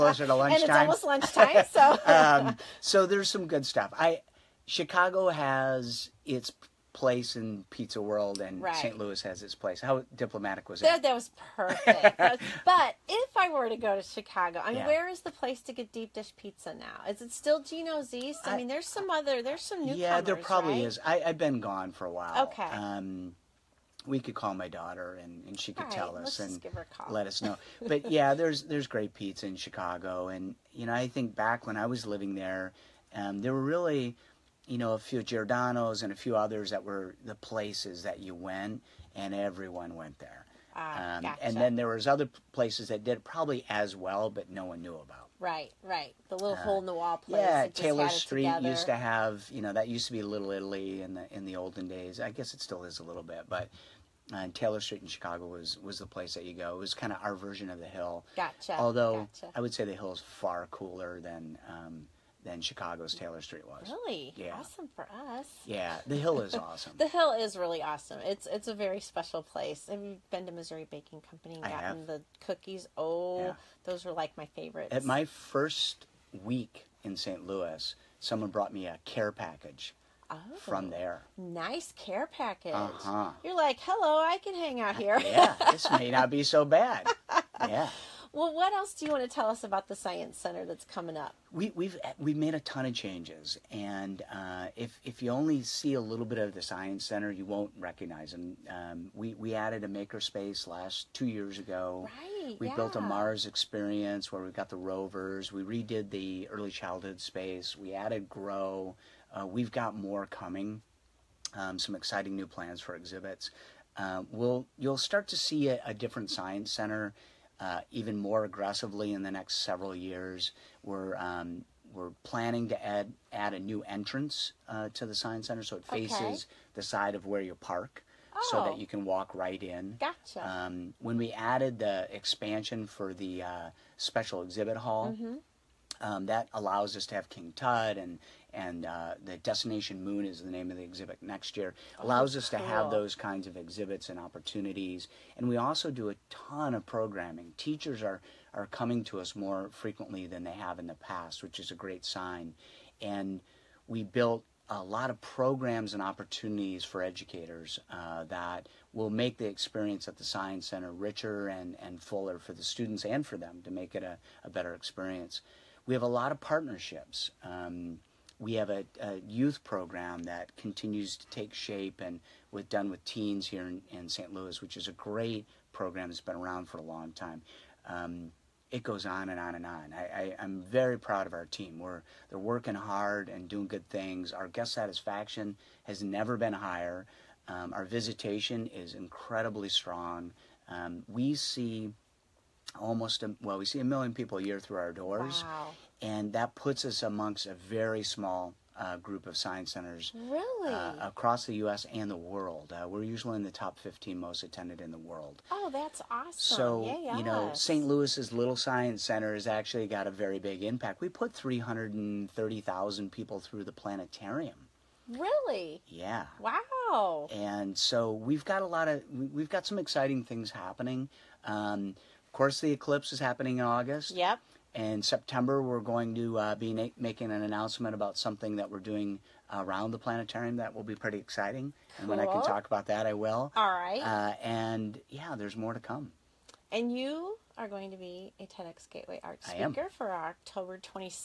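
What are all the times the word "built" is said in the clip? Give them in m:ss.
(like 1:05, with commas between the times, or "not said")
1:42, 2:34.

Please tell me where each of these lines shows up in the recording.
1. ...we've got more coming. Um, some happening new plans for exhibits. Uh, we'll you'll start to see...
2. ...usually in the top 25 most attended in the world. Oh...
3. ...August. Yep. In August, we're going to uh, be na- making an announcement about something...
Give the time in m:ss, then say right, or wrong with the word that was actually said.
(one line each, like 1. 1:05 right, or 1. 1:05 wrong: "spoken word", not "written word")
1. 1:49 wrong: "exciting", not "happening"
2. 3:23 wrong: "15", not "25"
3. 3:43 wrong: "September", not "August".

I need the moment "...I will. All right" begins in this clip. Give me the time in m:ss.
3:53.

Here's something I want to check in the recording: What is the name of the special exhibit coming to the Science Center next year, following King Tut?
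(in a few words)
Destination Moon.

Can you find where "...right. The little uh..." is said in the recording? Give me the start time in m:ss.
0:45.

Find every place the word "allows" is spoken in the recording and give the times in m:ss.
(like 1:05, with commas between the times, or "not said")
2:16, 2:21.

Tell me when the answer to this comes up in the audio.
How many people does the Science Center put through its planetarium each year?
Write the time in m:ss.
3:31.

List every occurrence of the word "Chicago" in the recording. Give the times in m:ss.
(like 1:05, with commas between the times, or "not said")
0:04, 0:14, 0:29, 0:55, 1:02.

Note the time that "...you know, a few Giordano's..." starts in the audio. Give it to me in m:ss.
0:34.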